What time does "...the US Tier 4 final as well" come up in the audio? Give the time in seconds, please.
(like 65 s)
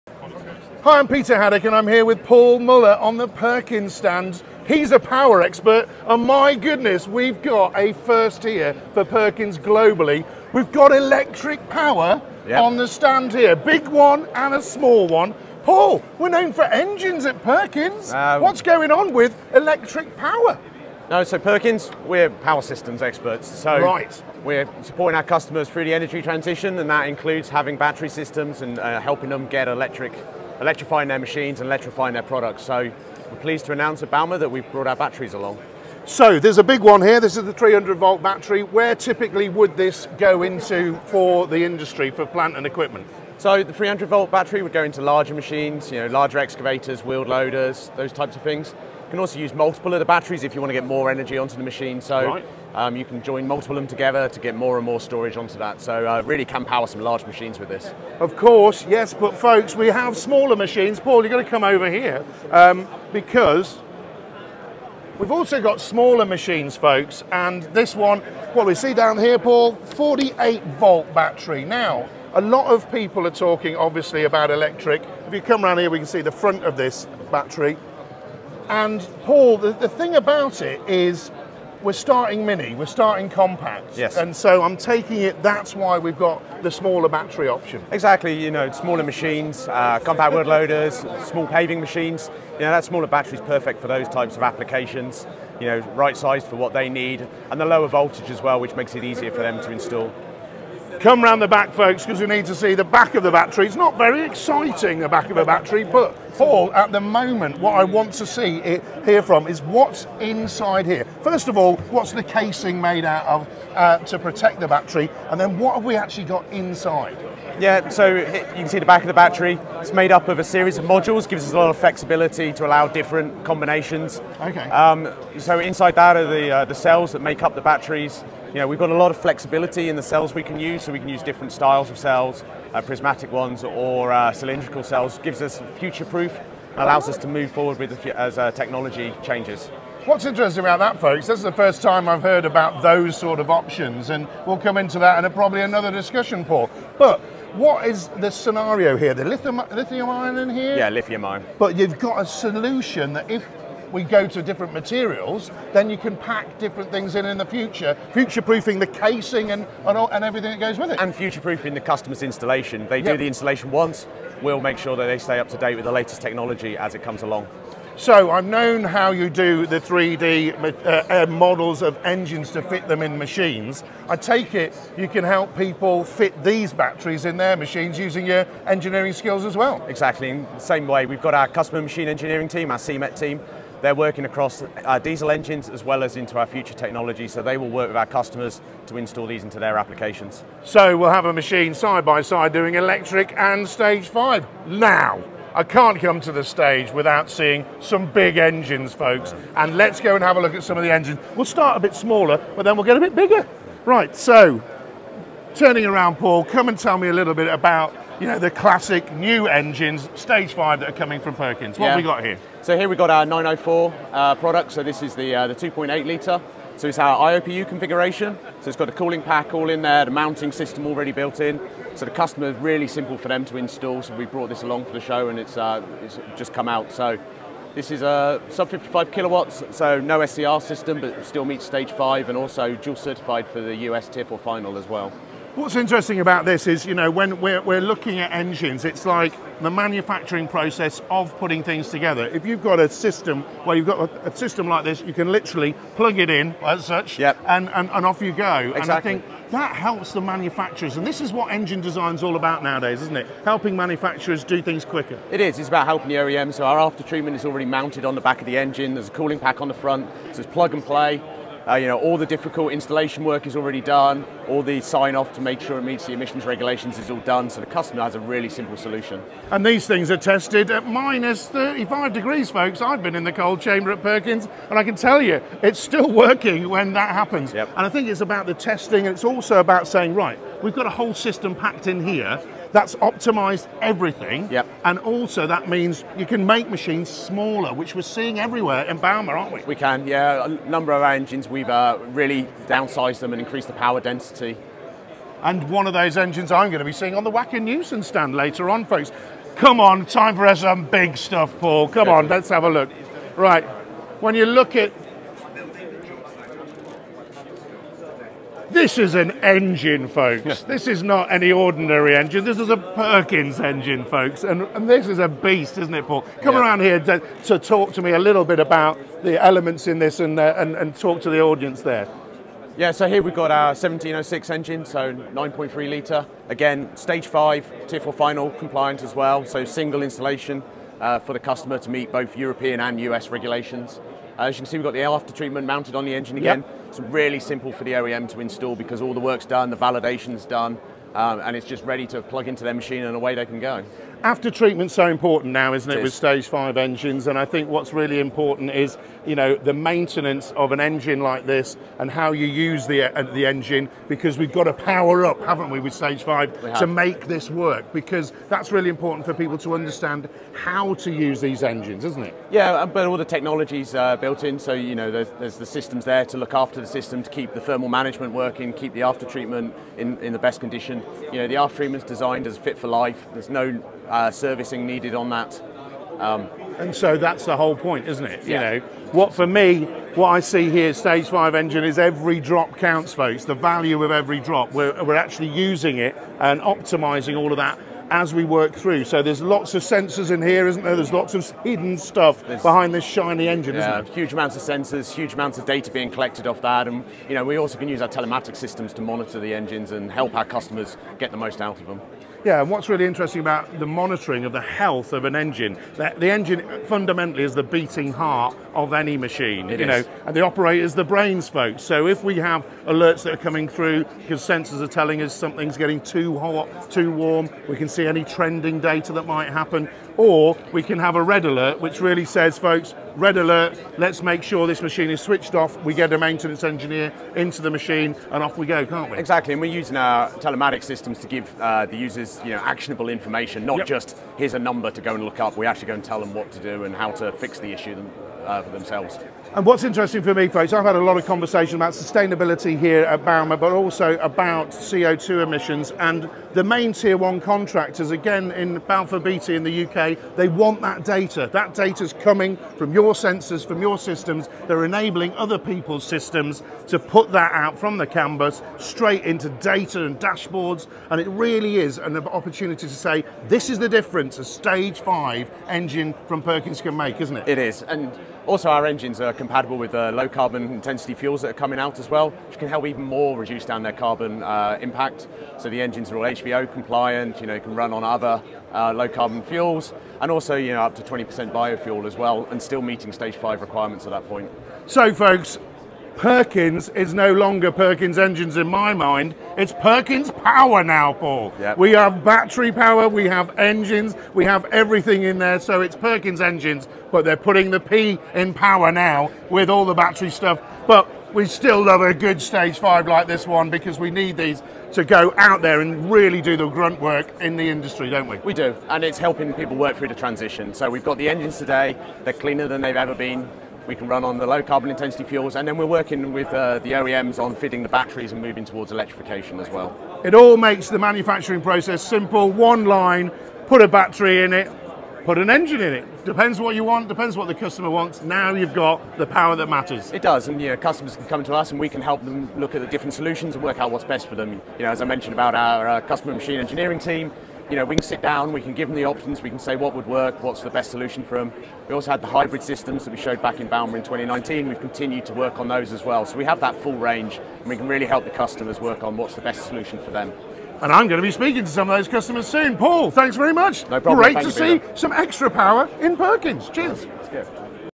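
233 s.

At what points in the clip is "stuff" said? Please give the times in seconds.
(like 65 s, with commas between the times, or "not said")
301 s, 391 s, 500 s.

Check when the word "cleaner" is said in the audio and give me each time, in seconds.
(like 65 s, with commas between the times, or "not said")
512 s.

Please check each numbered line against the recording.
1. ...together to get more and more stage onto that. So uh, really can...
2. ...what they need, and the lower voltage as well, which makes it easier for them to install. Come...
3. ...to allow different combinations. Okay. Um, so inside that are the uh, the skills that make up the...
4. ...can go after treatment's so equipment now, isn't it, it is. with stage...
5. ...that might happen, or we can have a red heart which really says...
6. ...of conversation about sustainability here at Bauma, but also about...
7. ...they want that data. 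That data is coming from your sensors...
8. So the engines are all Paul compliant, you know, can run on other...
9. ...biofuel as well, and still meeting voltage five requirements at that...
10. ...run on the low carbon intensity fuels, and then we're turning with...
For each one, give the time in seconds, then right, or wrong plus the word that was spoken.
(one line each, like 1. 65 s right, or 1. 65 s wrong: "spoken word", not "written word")
1. 53 s wrong: "storage", not "stage"
2. 96 s right
3. 122 s wrong: "cells", not "skills"
4. 343 s wrong: "important", not "equipment"
5. 419 s wrong: "alert", not "heart"
6. 441 s right
7. 450 s right
8. 475 s wrong: "HVO", not "Paul"
9. 481 s wrong: "stage", not "voltage"
10. 514 s wrong: "working", not "turning".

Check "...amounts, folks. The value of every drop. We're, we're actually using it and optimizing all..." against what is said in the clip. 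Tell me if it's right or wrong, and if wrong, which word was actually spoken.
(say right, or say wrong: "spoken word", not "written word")
wrong: "counts", not "amounts".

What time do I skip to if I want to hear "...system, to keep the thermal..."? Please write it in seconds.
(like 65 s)
366 s.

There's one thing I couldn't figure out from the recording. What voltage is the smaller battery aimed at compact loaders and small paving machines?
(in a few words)
48 volt.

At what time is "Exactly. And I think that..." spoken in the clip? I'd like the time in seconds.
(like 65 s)
248 s.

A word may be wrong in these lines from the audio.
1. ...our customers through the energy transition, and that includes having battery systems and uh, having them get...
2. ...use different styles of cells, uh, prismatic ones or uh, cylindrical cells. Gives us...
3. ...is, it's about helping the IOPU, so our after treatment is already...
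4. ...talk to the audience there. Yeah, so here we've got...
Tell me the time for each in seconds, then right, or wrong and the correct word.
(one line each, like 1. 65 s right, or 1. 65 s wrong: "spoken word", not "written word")
1. 25 s wrong: "helping", not "having"
2. 131 s right
3. 255 s wrong: "OEM", not "IOPU"
4. 320 s right.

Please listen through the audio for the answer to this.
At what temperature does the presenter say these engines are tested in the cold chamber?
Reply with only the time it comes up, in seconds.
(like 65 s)
270 s.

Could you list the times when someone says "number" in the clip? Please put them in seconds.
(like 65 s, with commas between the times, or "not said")
290 s, 434 s.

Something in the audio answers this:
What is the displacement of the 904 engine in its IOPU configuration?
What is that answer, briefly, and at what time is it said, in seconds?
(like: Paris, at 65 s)
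2.8 litre, at 215 s.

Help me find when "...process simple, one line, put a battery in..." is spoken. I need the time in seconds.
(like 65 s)
521 s.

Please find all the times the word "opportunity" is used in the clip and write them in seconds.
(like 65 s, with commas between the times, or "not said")
462 s.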